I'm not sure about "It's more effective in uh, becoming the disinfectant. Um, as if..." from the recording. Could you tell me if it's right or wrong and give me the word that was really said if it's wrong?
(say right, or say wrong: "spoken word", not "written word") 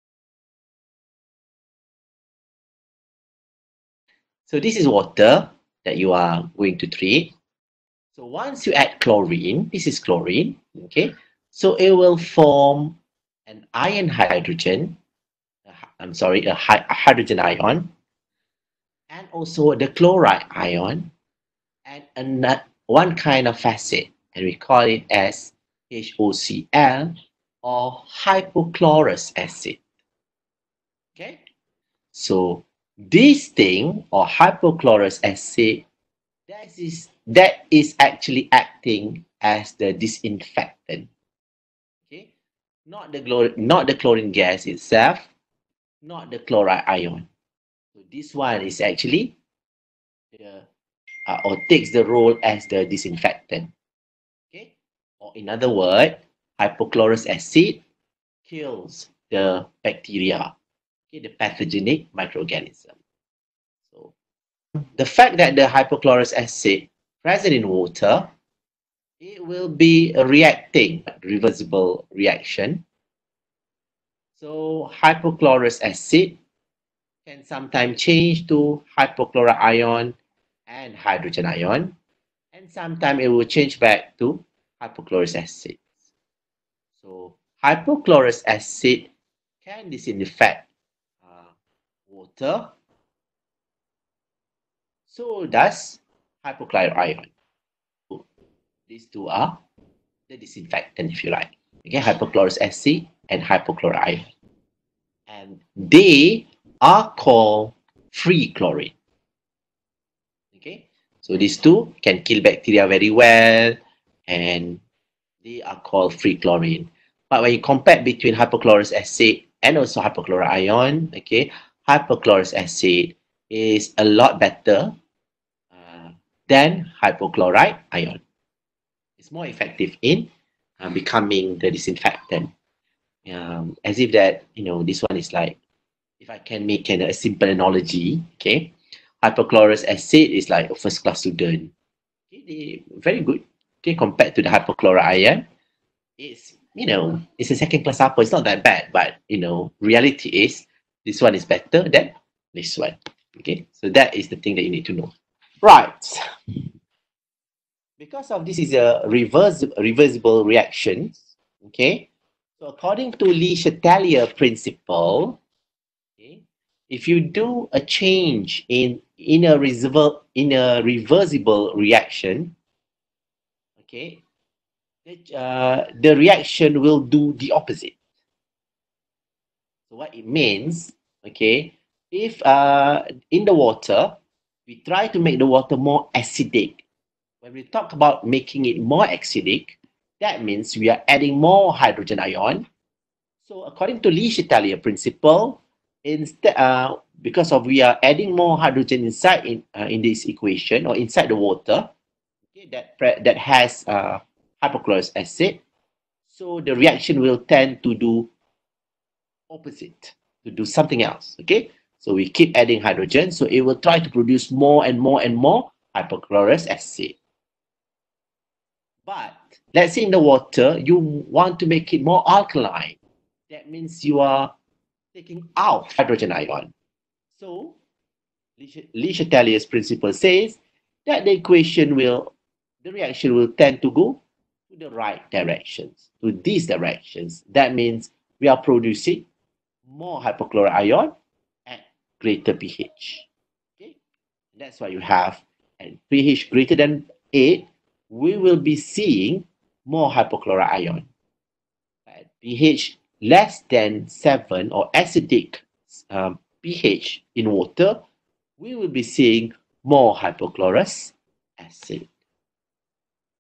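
right.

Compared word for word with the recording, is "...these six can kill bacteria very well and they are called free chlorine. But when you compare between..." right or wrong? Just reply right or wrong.
wrong.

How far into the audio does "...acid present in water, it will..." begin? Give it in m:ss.
1:06.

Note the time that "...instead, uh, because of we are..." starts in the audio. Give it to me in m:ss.
3:16.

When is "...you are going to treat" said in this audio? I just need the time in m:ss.
0:05.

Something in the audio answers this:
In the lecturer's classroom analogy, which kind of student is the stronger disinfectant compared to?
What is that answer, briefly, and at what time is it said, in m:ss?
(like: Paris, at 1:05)
first class student, at 2:20.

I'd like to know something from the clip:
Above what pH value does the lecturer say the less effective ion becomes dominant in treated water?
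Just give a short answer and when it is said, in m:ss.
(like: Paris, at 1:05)
8, at 4:07.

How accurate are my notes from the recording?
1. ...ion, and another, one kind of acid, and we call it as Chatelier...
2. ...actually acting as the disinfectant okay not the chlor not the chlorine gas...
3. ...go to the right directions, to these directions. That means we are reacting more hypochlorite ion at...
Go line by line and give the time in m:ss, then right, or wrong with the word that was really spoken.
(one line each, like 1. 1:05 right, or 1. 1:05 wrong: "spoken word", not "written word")
1. 0:20 wrong: "HOCl", not "Chatelier"
2. 0:37 right
3. 3:53 wrong: "producing", not "reacting".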